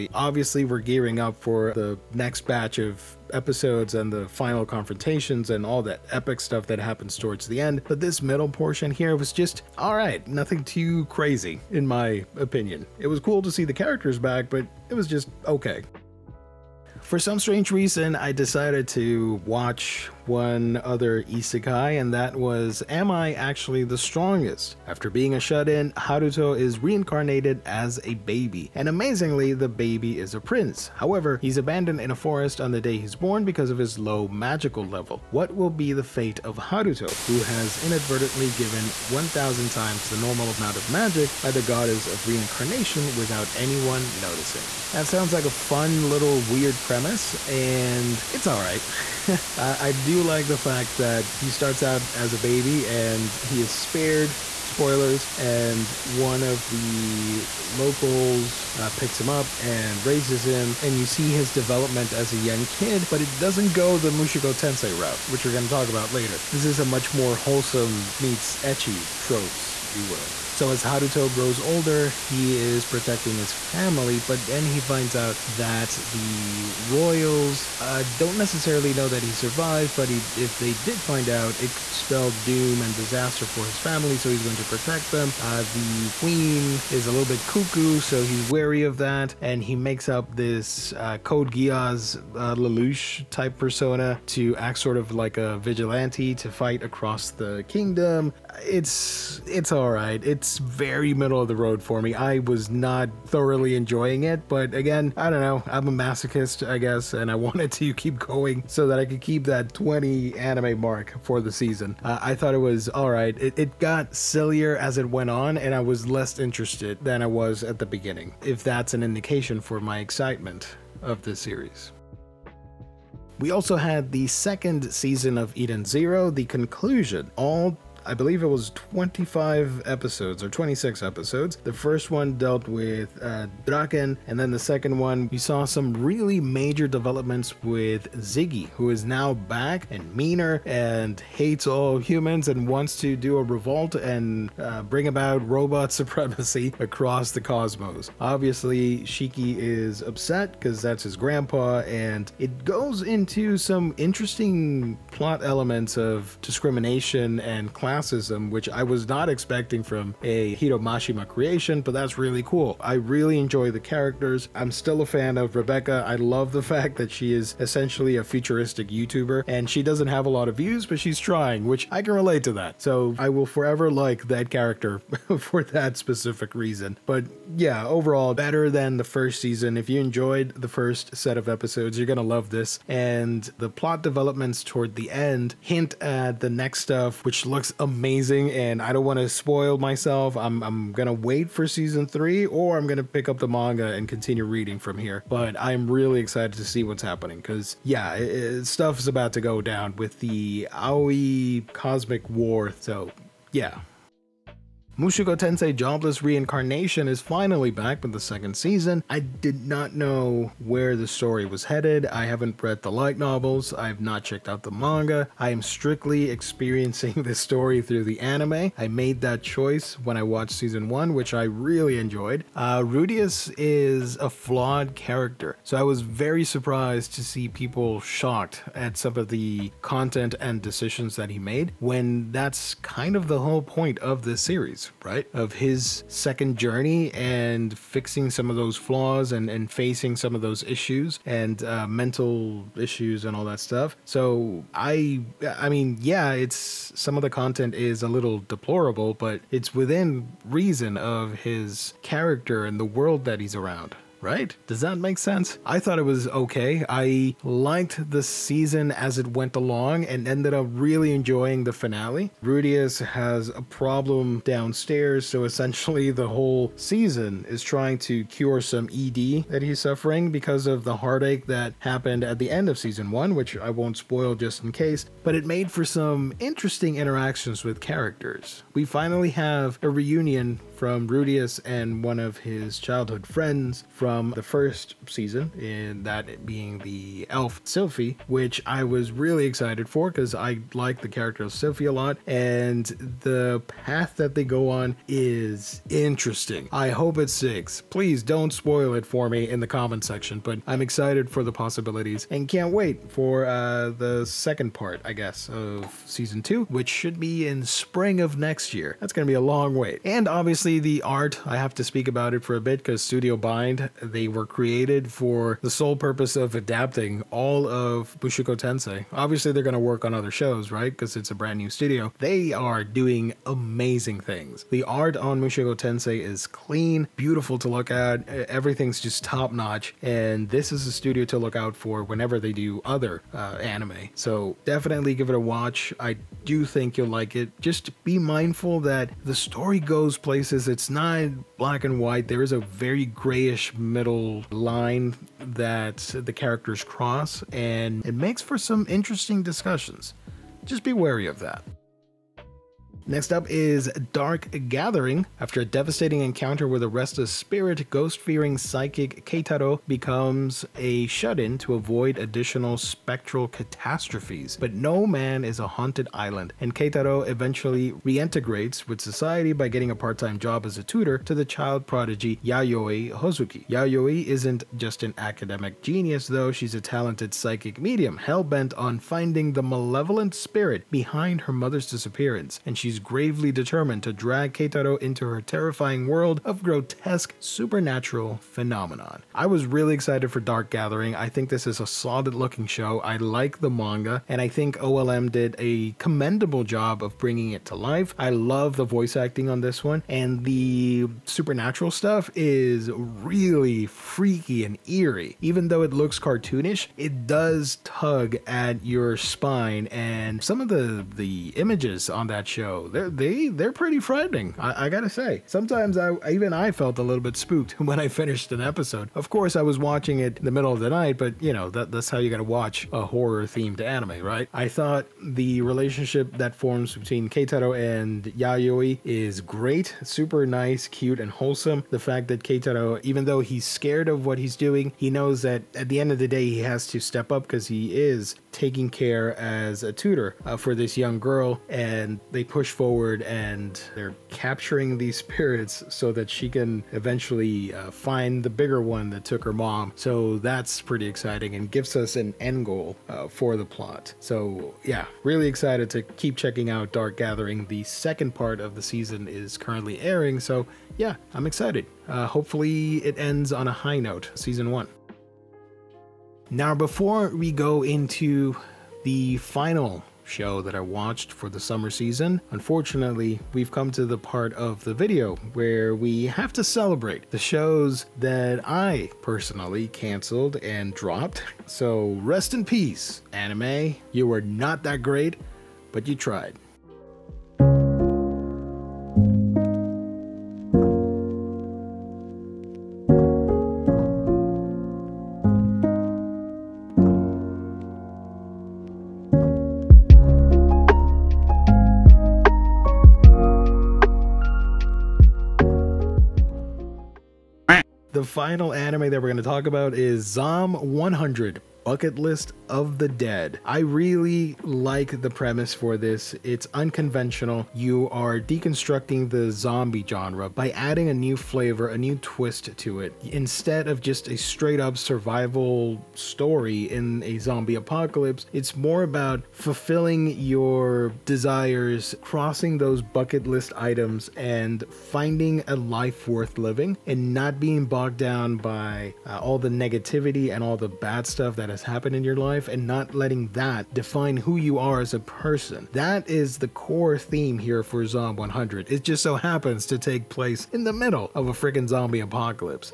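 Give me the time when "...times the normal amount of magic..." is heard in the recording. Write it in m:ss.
0:39.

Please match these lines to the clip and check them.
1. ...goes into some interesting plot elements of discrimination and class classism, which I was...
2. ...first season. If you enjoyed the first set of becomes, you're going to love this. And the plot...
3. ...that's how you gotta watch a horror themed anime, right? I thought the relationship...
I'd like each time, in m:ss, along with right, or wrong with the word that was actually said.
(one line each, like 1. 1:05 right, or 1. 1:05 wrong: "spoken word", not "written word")
1. 2:32 right
2. 2:59 wrong: "episodes", not "becomes"
3. 7:01 right.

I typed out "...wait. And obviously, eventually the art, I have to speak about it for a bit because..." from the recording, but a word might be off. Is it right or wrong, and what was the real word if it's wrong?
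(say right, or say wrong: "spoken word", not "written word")
wrong: "obviously", not "eventually".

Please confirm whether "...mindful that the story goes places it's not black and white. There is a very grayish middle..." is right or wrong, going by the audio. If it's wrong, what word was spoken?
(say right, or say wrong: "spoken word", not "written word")
right.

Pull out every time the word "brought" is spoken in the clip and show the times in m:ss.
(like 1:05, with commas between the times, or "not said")
not said.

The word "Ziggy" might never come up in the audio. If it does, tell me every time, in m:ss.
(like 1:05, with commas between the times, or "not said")
2:18.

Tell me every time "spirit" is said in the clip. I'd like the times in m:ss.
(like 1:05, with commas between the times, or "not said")
5:57, 6:20, 7:25.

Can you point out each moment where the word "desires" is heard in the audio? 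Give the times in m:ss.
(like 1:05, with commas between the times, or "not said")
8:51.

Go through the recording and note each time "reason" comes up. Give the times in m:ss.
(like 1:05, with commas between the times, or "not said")
0:17, 2:56, 4:10.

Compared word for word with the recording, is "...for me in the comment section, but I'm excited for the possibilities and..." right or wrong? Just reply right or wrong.
right.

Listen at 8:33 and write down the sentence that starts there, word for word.
I really like the premise for this.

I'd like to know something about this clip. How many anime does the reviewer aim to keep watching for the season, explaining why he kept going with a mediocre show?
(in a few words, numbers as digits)
20.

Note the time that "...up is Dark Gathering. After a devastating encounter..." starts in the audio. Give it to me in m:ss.
5:53.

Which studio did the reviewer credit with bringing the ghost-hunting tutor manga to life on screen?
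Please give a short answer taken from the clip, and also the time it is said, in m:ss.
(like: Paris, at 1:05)
OLM, at 6:34.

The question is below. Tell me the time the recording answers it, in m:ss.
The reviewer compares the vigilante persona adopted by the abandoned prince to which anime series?
1:31.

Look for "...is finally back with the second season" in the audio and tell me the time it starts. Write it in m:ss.
3:27.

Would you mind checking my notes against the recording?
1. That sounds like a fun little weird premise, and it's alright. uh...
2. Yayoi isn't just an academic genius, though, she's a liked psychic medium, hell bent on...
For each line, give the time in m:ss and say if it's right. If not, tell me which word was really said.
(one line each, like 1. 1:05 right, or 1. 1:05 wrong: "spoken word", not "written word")
1. 0:44 right
2. 6:13 wrong: "talented", not "liked".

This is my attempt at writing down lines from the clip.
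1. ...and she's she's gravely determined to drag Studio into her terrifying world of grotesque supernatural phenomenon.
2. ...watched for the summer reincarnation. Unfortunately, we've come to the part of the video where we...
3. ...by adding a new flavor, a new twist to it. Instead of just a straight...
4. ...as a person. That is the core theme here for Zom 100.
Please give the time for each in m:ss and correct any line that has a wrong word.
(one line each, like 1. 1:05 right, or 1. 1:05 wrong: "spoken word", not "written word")
1. 6:22 wrong: "Keitaro", not "Studio"
2. 7:50 wrong: "season", not "reincarnation"
3. 8:40 right
4. 9:04 right.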